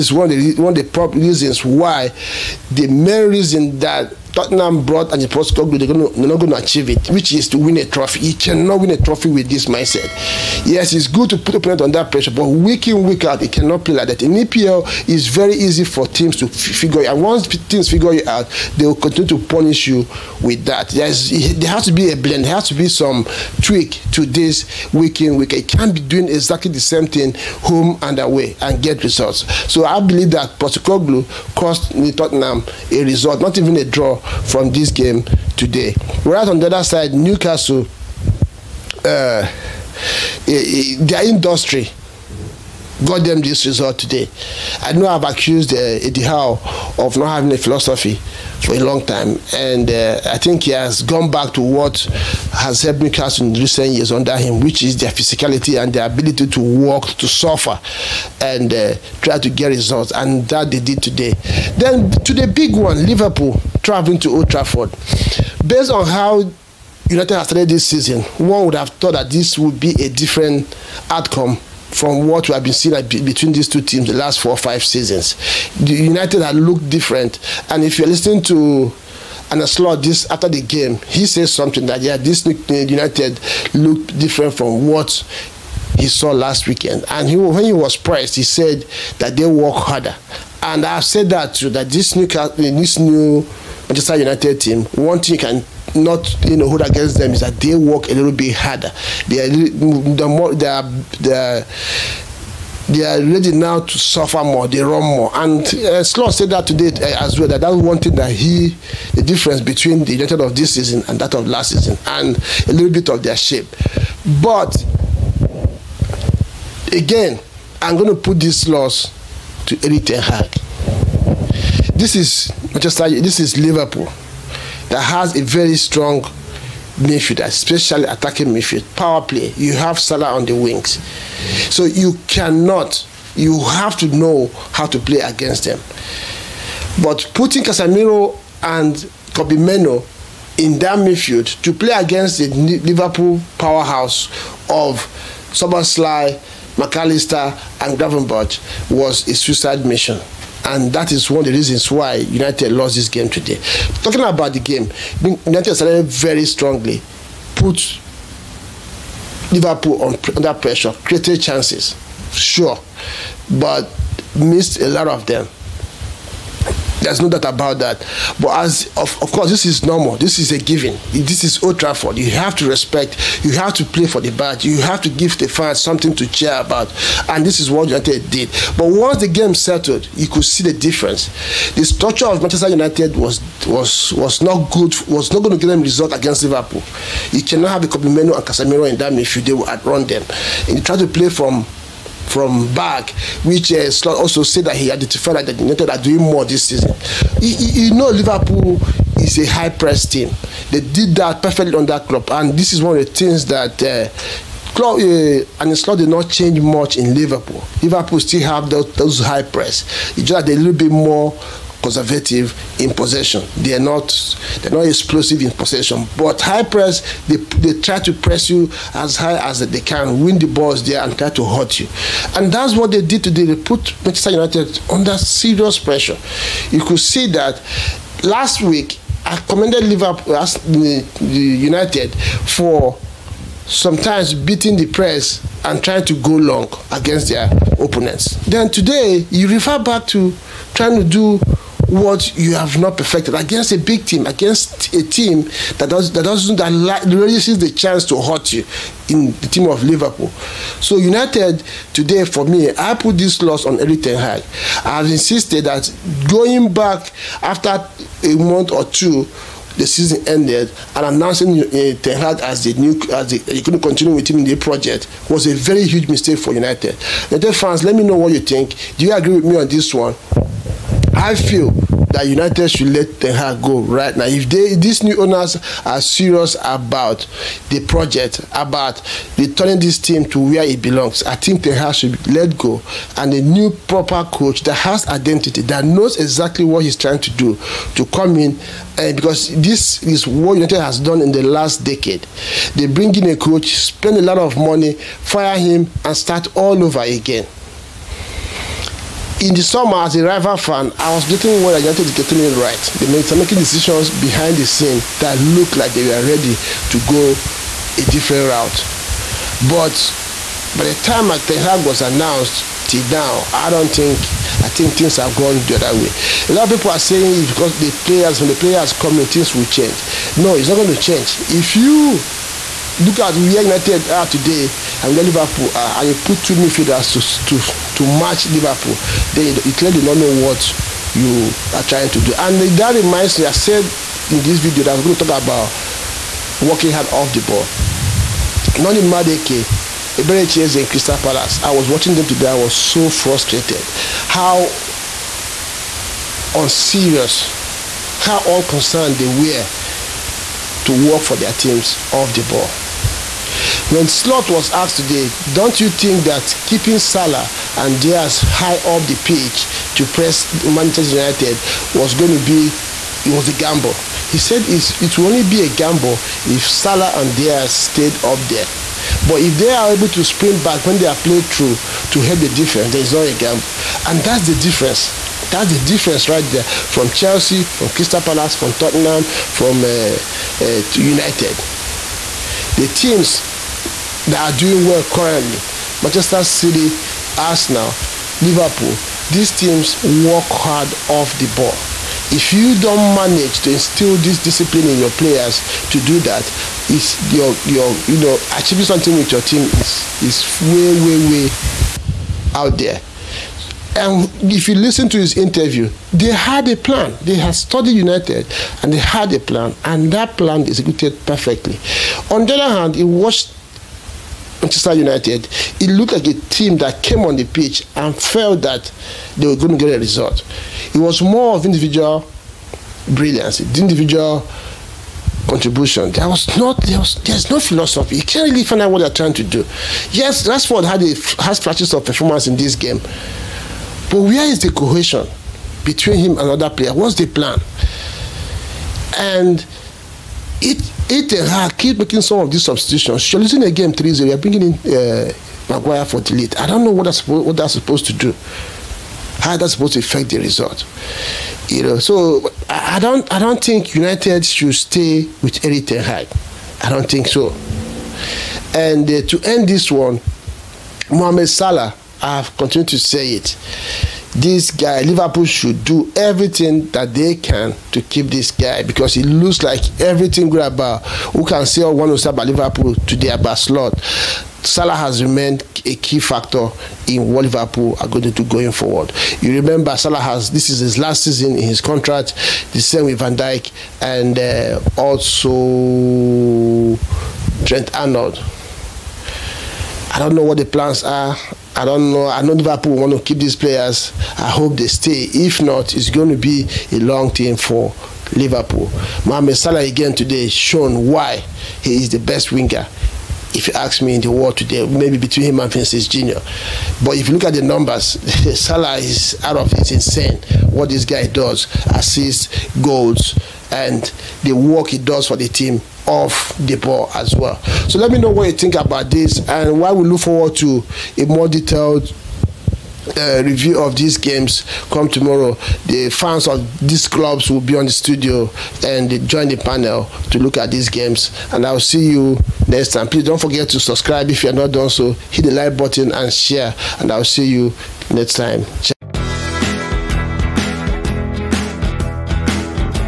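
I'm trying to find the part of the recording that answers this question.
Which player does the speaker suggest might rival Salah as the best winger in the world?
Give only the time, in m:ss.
8:25.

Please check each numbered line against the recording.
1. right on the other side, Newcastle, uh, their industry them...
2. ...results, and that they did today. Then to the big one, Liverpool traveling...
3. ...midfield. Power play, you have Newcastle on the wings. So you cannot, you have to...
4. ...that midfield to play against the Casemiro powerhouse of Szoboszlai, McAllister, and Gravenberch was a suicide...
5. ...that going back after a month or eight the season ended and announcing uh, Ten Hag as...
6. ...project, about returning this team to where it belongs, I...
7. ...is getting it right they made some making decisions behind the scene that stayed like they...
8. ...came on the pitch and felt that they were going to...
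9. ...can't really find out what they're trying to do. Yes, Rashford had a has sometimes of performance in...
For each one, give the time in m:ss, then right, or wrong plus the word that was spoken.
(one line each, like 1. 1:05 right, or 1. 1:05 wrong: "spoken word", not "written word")
1. 0:36 right
2. 0:59 right
3. 2:08 wrong: "Salah", not "Newcastle"
4. 2:20 wrong: "Liverpool", not "Casemiro"
5. 4:15 wrong: "two", not "eight"
6. 4:37 right
7. 5:02 wrong: "looked", not "stayed"
8. 6:57 right
9. 7:08 wrong: "flashes", not "sometimes".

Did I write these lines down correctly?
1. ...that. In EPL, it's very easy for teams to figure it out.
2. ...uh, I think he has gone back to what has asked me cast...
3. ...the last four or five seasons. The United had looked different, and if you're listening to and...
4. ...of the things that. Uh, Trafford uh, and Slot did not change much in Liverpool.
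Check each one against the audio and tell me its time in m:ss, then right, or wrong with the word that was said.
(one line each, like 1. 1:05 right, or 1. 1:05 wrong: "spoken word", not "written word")
1. 0:14 right
2. 0:49 wrong: "helped", not "asked"
3. 1:14 right
4. 3:22 wrong: "Klopp", not "Trafford".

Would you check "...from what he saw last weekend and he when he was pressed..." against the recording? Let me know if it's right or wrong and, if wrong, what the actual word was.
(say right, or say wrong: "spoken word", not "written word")
right.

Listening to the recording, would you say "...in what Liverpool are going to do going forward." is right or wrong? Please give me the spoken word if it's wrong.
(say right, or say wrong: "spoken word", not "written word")
right.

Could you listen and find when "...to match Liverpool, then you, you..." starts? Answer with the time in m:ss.
5:27.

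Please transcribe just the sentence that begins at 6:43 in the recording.
And if you listen to his interview, they had a plan.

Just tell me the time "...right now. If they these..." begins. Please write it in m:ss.
4:33.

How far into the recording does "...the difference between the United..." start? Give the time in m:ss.
1:49.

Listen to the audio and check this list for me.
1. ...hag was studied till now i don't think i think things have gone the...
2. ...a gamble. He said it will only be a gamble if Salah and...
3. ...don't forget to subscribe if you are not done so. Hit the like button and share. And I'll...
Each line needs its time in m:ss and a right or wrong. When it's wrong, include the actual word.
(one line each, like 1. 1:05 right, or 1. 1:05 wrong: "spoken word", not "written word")
1. 5:11 wrong: "announced", not "studied"
2. 6:03 right
3. 8:53 right.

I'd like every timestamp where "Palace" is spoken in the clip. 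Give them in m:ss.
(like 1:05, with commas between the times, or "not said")
5:41, 6:18.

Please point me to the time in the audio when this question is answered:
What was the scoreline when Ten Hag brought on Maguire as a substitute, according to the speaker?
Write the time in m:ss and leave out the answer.
7:23.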